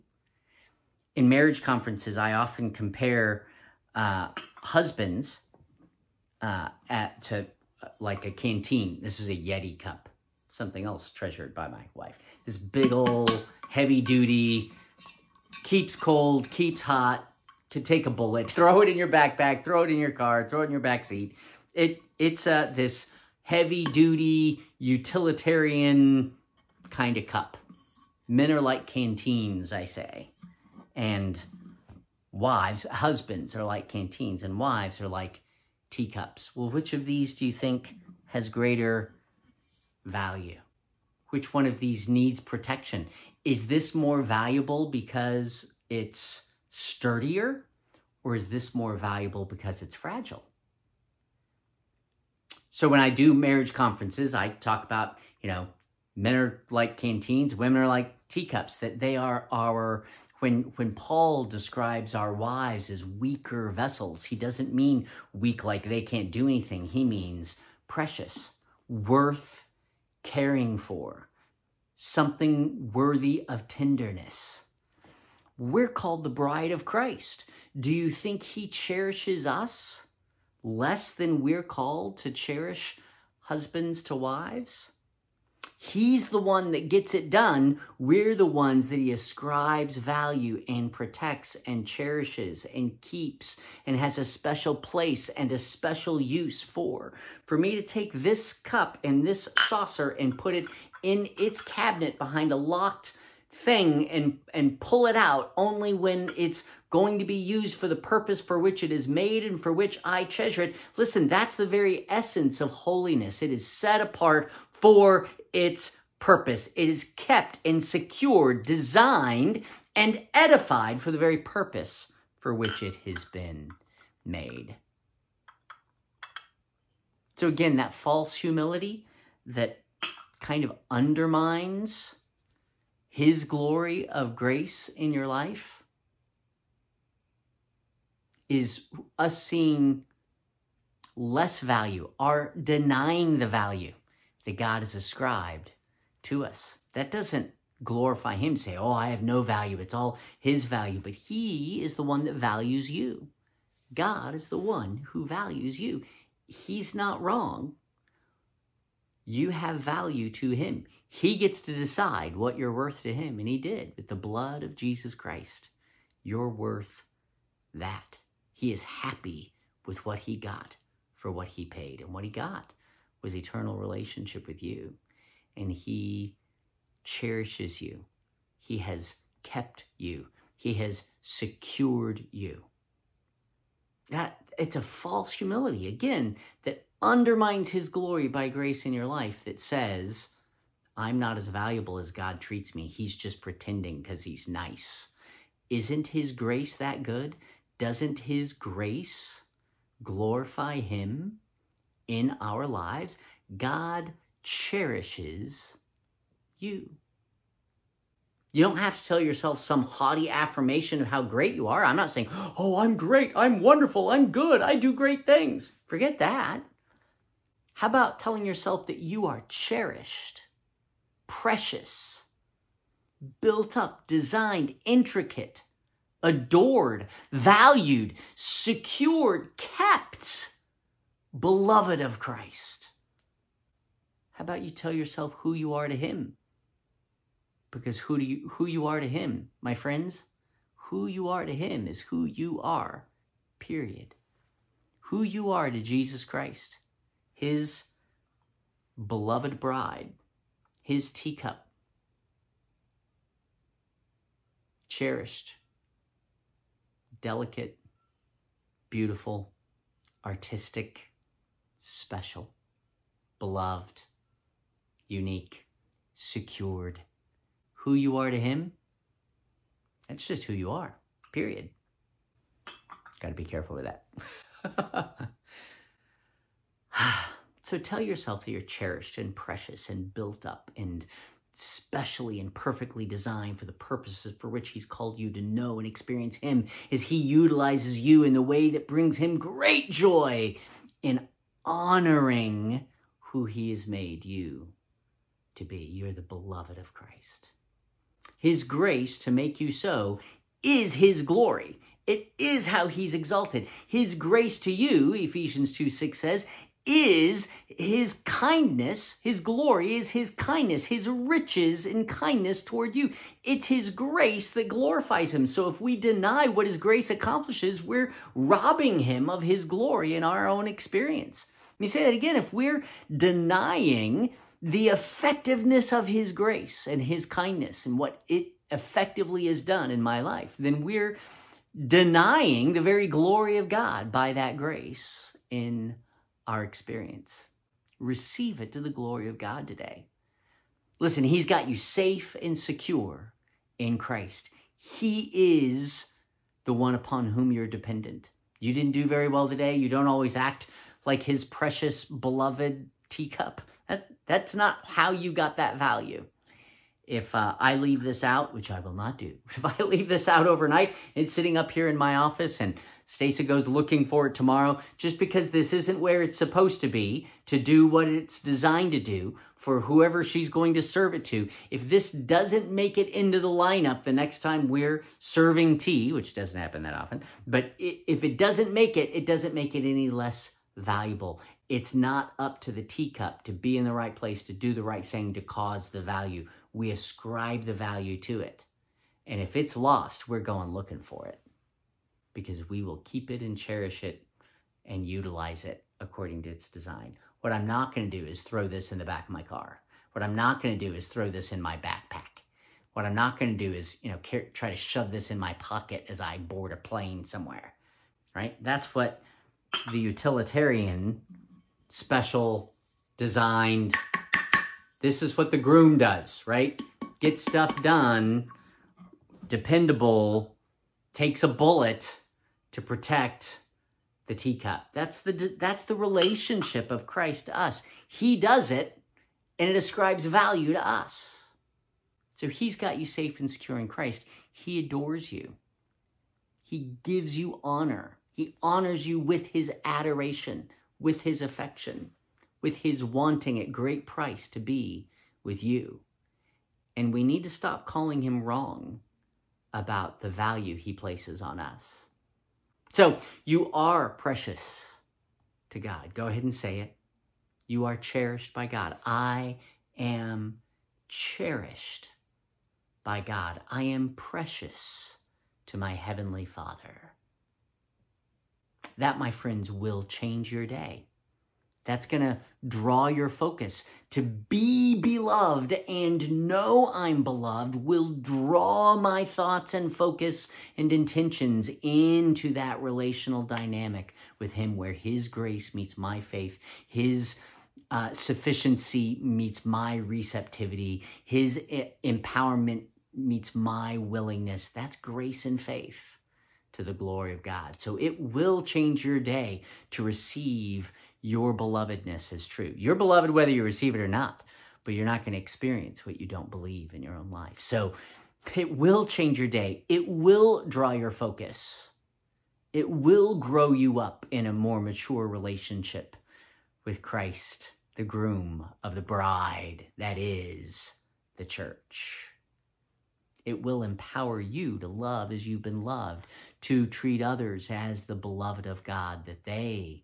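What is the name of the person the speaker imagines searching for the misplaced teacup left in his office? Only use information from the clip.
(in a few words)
Stacey.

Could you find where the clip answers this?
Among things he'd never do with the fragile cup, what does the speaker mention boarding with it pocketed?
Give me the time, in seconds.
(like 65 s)
406 s.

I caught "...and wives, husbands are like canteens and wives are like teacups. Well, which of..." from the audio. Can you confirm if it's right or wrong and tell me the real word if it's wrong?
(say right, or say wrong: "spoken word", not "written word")
right.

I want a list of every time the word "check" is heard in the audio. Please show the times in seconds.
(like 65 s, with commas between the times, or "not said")
not said.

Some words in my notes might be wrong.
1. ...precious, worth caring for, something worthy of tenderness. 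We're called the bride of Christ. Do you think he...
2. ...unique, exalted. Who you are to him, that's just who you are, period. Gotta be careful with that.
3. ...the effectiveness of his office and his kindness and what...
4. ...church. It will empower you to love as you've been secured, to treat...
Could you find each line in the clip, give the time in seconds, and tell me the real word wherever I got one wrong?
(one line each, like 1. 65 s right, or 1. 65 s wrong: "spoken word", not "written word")
1. 67 s right
2. 265 s wrong: "secured", not "exalted"
3. 324 s wrong: "grace", not "office"
4. 521 s wrong: "loved", not "secured".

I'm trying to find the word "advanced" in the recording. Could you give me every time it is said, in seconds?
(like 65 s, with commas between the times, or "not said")
not said.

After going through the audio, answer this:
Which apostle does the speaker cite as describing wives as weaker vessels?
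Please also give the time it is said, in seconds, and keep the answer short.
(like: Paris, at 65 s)
Paul, at 60 s.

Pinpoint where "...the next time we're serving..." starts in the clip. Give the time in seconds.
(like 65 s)
374 s.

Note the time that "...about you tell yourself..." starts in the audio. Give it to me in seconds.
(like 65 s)
234 s.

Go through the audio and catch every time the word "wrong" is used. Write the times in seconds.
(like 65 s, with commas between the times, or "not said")
157 s, 448 s.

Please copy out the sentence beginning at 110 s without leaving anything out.
Listen, that's the very essence of holiness.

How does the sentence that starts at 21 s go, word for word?
It it's uh, this heavy duty utilitarian kind of cup.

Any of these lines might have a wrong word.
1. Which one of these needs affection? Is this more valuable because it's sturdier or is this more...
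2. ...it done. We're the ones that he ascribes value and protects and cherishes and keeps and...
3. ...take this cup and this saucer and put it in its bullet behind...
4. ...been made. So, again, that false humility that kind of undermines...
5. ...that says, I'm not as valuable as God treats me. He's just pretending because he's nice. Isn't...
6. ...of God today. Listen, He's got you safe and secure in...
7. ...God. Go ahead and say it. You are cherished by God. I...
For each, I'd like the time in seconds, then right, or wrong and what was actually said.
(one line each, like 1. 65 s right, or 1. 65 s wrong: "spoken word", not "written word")
1. 41 s wrong: "protection", not "affection"
2. 87 s right
3. 97 s wrong: "cabinet", not "bullet"
4. 123 s right
5. 189 s right
6. 339 s right
7. 455 s right.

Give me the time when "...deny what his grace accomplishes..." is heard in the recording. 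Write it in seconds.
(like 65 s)
315 s.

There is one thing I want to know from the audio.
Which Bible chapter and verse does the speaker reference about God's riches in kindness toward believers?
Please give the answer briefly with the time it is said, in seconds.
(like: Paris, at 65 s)
Ephesians 2:6, at 305 s.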